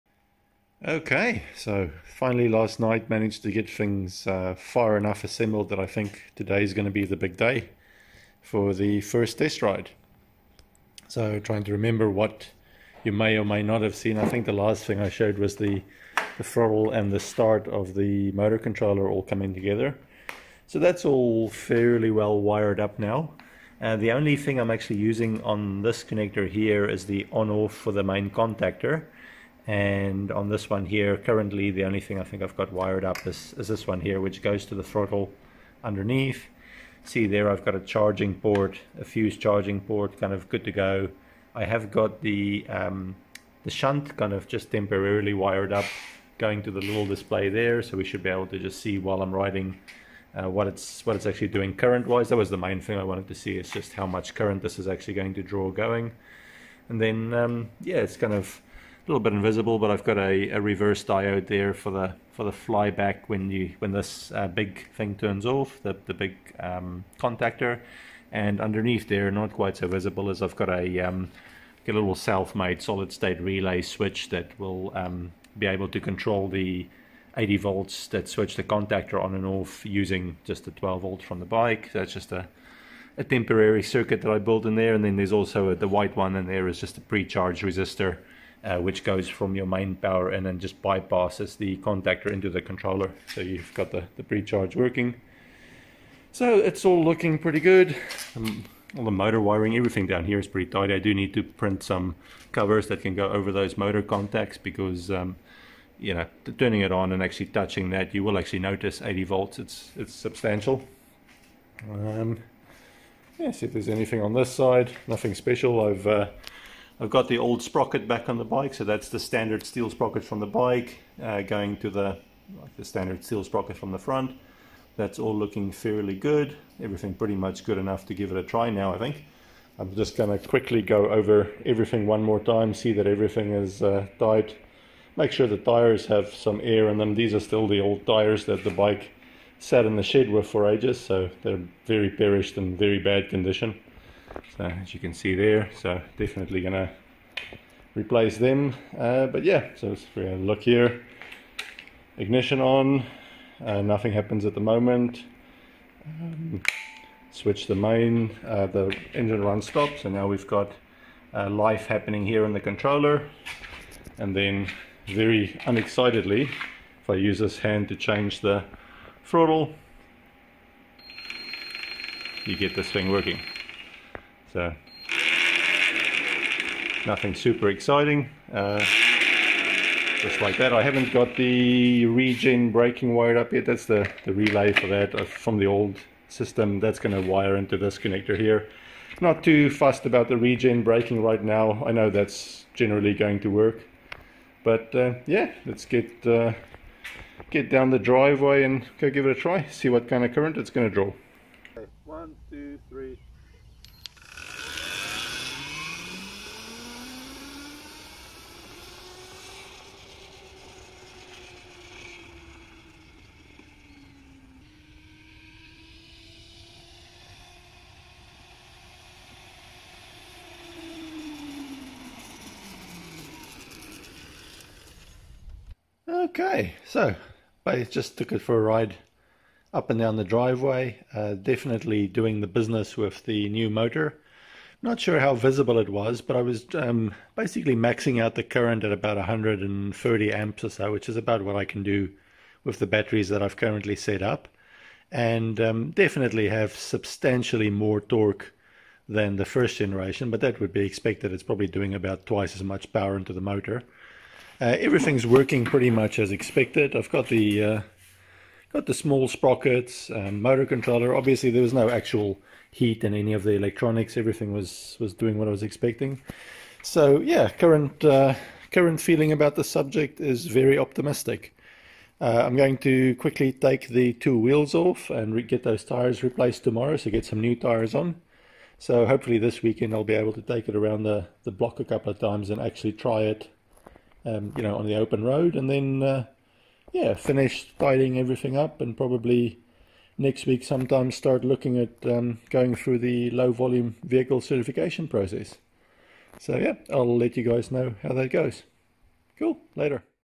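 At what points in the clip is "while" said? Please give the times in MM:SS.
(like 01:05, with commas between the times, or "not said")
00:48.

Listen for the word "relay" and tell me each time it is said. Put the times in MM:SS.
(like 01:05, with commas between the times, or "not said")
01:13, 03:04.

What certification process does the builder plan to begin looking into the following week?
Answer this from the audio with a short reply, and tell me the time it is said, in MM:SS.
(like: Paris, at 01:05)
low volume vehicle certification, at 04:53.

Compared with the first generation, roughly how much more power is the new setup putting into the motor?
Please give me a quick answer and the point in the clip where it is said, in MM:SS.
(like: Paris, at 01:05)
twice as much, at 04:12.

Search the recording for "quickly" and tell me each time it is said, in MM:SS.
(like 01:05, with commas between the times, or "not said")
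02:10, 04:33.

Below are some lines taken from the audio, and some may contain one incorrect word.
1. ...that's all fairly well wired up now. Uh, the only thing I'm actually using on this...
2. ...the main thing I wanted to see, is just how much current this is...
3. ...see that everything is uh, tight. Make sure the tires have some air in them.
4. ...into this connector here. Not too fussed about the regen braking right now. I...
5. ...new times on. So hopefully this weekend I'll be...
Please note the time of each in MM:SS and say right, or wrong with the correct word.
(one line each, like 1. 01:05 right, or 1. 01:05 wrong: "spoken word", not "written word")
1. 00:20 right
2. 00:52 right
3. 02:12 right
4. 03:07 right
5. 04:37 wrong: "tires", not "times".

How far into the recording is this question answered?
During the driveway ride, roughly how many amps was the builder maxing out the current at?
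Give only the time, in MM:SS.
03:59.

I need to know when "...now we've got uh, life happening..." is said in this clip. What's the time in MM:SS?
02:40.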